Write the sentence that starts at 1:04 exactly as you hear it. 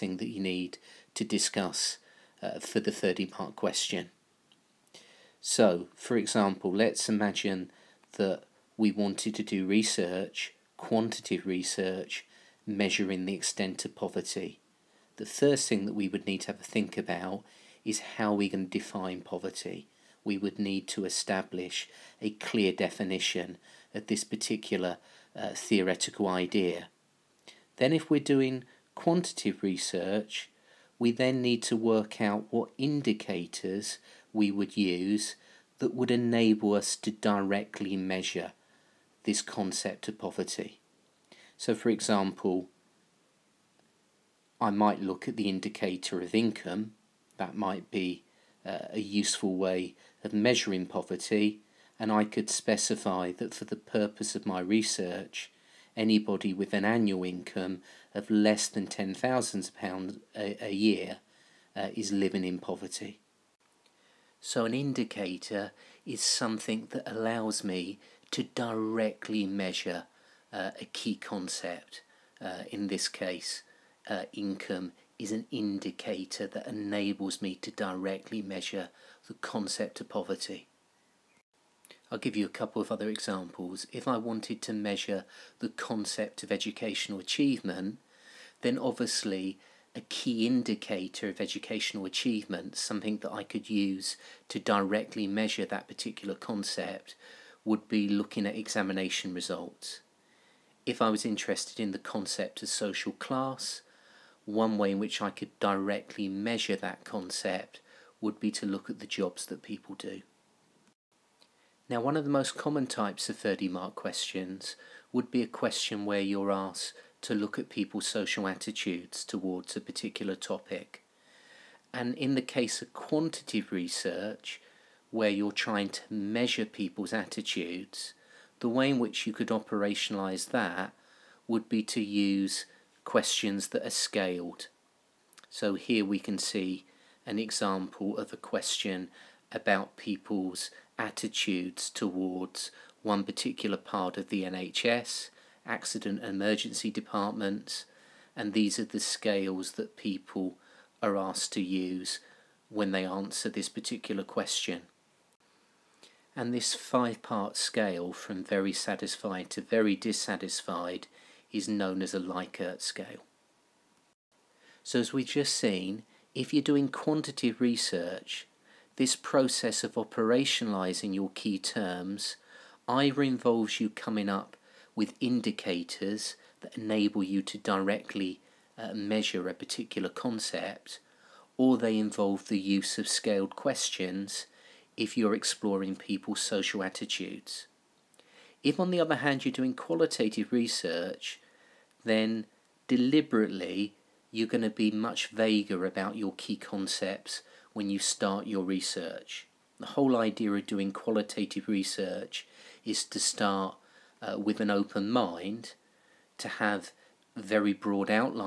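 So, an indicator is something that allows me to directly measure uh, a key concept.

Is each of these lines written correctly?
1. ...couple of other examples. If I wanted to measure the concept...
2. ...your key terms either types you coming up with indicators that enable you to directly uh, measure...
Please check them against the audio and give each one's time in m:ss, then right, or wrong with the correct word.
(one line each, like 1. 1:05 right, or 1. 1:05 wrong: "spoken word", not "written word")
1. 1:22 right
2. 2:51 wrong: "involves", not "types".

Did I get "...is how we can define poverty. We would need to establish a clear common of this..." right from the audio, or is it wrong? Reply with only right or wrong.
wrong.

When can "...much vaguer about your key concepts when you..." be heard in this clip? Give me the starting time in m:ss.
3:14.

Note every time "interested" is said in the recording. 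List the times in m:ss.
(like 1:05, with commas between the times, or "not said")
1:41.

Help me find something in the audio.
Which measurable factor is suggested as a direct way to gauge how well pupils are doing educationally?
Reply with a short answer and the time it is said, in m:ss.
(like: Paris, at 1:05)
Examination results, at 1:38.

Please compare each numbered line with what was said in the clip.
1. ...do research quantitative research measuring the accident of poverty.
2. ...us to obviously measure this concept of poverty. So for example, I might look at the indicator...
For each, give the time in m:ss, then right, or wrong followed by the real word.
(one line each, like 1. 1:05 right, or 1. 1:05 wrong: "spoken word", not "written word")
1. 0:09 wrong: "extent", not "accident"
2. 0:36 wrong: "directly", not "obviously".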